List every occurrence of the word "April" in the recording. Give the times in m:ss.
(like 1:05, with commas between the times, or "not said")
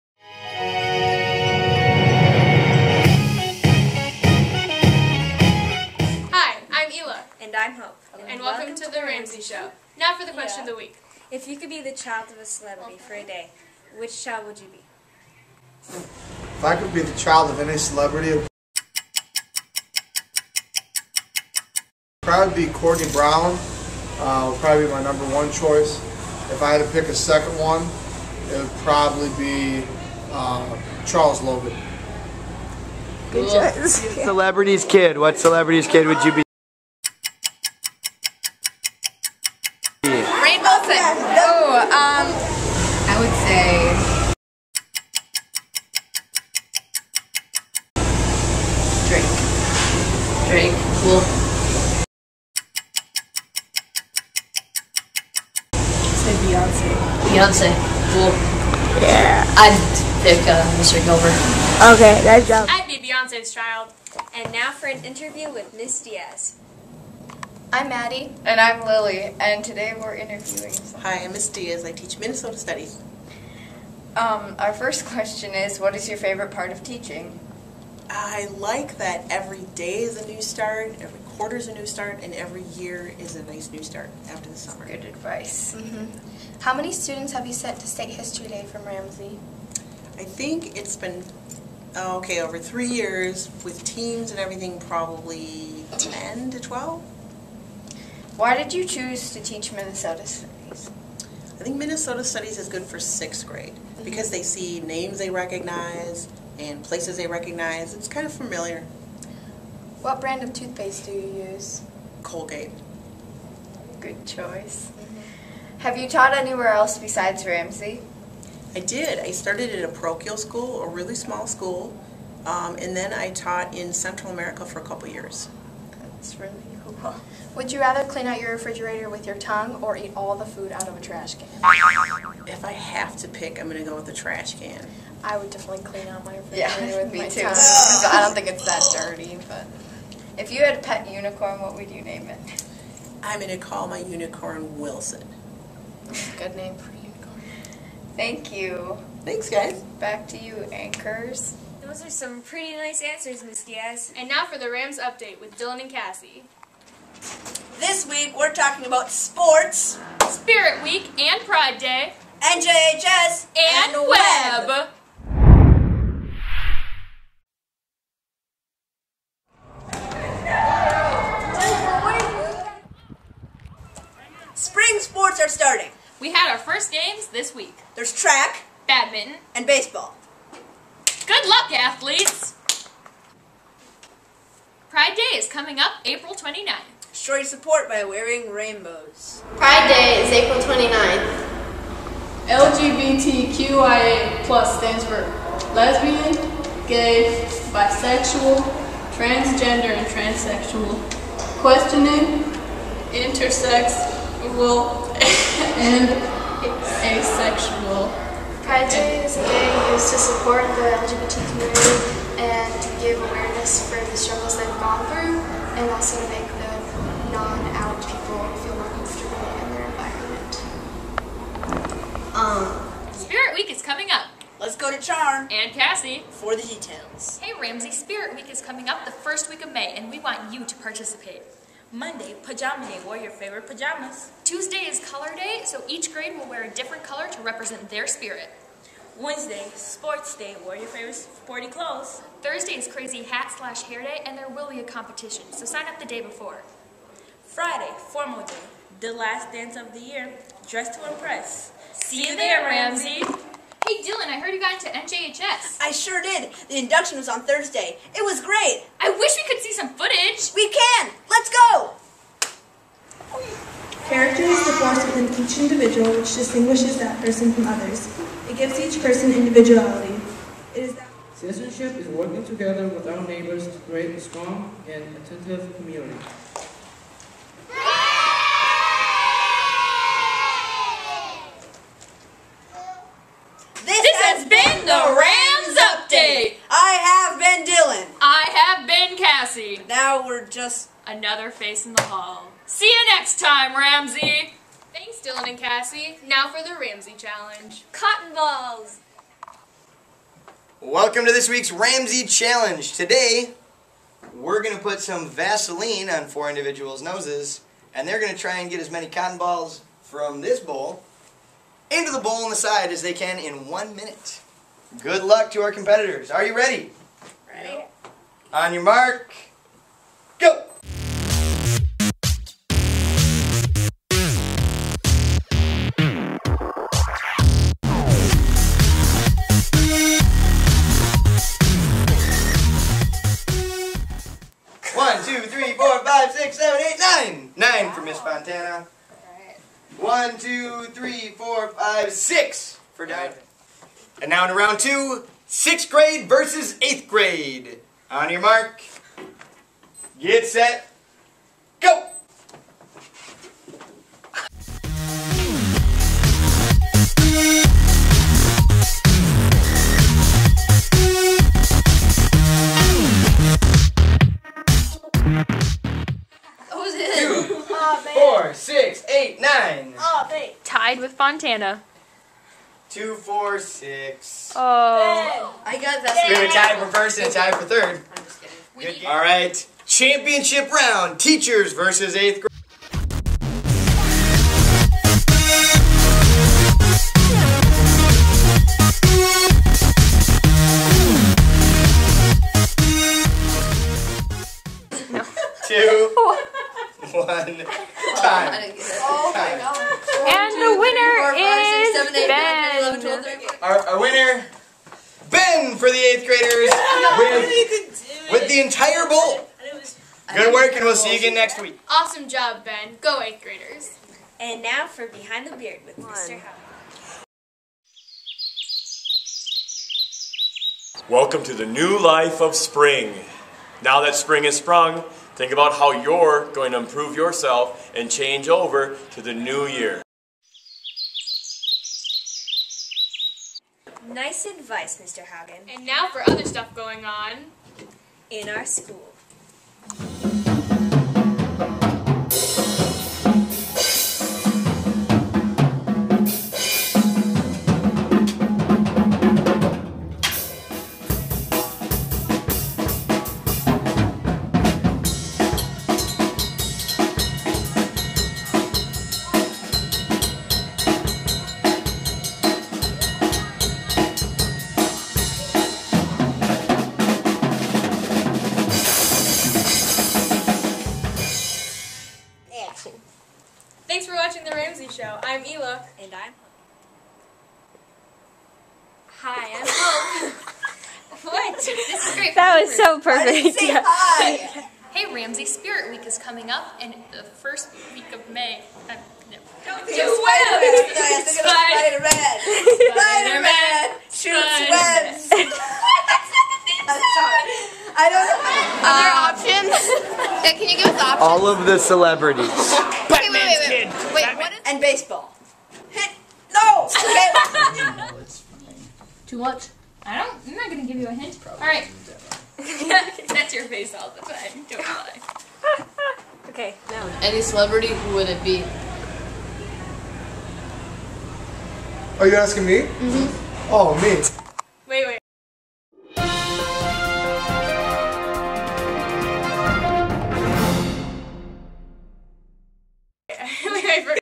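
3:06, 3:10.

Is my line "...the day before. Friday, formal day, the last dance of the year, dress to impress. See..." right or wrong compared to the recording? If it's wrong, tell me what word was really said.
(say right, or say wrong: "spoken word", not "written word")
right.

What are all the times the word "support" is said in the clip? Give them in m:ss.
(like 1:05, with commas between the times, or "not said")
3:07, 3:30.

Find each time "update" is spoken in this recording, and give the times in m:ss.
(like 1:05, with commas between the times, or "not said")
2:34, 4:45.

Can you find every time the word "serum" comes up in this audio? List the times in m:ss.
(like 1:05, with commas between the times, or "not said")
not said.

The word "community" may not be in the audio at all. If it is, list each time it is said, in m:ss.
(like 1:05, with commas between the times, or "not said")
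3:31, 4:35.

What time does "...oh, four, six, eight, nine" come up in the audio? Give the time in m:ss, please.
6:07.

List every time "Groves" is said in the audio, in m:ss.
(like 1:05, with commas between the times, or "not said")
not said.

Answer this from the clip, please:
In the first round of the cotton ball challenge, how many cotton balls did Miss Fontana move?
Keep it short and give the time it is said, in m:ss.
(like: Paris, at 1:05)
9, at 5:37.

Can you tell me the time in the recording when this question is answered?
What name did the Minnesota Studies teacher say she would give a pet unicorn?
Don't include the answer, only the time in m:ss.
2:24.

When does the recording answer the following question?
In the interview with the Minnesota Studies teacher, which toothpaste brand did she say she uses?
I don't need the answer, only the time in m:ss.
1:52.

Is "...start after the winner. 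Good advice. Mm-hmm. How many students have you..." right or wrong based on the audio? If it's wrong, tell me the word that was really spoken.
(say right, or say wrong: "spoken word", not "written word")
wrong: "summer", not "winner".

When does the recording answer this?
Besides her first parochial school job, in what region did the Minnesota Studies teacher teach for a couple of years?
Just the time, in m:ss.
2:03.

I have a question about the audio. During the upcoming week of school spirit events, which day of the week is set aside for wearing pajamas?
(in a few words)
Monday.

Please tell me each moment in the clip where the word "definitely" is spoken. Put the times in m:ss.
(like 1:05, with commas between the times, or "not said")
2:15.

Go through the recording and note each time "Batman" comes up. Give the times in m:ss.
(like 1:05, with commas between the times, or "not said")
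8:24.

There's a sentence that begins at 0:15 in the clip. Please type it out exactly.
If I could be the child of any celebrity, would probably be Courtney Brown.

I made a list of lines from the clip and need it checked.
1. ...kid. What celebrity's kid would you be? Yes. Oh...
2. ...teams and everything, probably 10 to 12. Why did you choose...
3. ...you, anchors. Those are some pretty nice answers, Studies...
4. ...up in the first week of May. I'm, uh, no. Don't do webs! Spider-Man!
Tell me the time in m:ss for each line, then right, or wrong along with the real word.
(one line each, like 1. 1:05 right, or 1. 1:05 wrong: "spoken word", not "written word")
1. 0:34 right
2. 1:33 right
3. 2:30 wrong: "Miss", not "Studies"
4. 8:06 right.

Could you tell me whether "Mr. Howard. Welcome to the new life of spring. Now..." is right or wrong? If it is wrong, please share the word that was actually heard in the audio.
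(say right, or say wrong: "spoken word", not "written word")
right.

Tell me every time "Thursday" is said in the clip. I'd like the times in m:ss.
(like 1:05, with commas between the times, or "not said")
4:02, 4:17.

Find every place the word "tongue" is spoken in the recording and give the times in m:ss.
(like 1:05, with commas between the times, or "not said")
2:09, 2:17.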